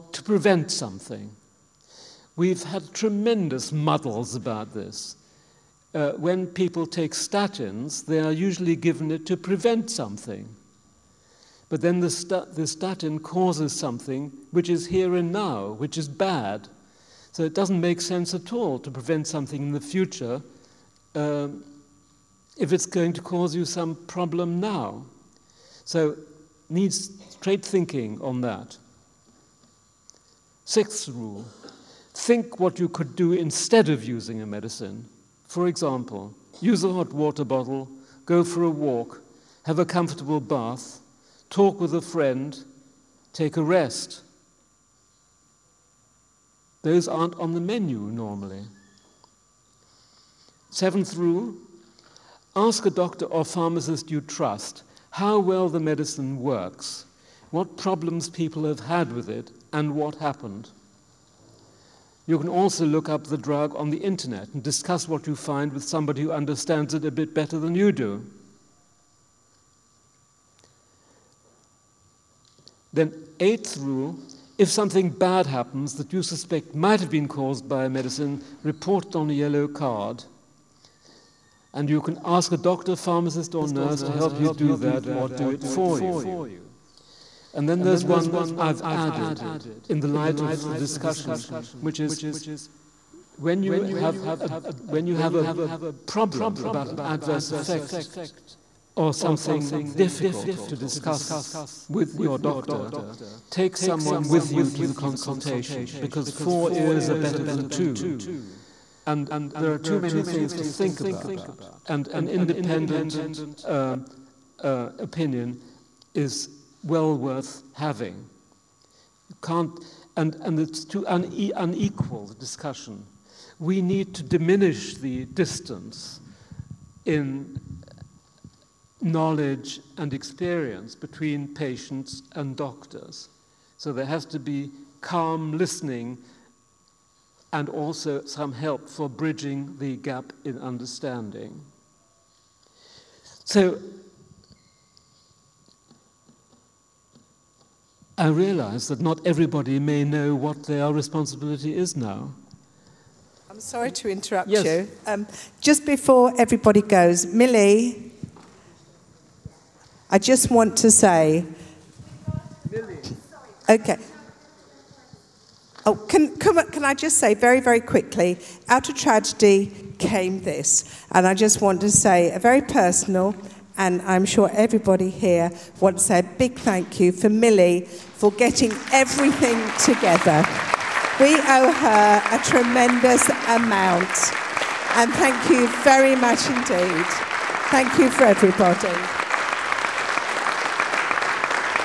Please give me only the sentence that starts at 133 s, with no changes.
So there has to be calm listening and also some help for bridging the gap in understanding.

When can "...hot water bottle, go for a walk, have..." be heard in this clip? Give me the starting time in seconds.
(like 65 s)
36 s.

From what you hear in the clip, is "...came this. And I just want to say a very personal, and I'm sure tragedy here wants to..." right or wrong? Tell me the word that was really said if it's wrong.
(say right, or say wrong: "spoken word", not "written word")
wrong: "everybody", not "tragedy".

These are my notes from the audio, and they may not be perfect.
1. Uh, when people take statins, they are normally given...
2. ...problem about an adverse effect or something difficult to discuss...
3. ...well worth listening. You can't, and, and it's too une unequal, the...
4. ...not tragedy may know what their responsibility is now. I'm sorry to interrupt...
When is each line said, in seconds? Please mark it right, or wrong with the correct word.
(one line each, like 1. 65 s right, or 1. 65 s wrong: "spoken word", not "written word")
1. 5 s wrong: "usually", not "normally"
2. 96 s right
3. 116 s wrong: "having", not "listening"
4. 148 s wrong: "everybody", not "tragedy".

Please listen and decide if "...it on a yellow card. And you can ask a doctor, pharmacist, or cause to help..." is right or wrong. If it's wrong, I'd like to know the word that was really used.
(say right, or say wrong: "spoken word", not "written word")
wrong: "nurse", not "cause".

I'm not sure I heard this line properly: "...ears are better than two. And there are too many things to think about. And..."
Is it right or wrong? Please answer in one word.
right.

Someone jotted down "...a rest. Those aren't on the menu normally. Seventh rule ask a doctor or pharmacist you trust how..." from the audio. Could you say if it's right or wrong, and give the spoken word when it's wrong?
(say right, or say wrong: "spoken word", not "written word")
right.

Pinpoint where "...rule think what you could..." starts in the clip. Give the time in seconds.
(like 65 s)
31 s.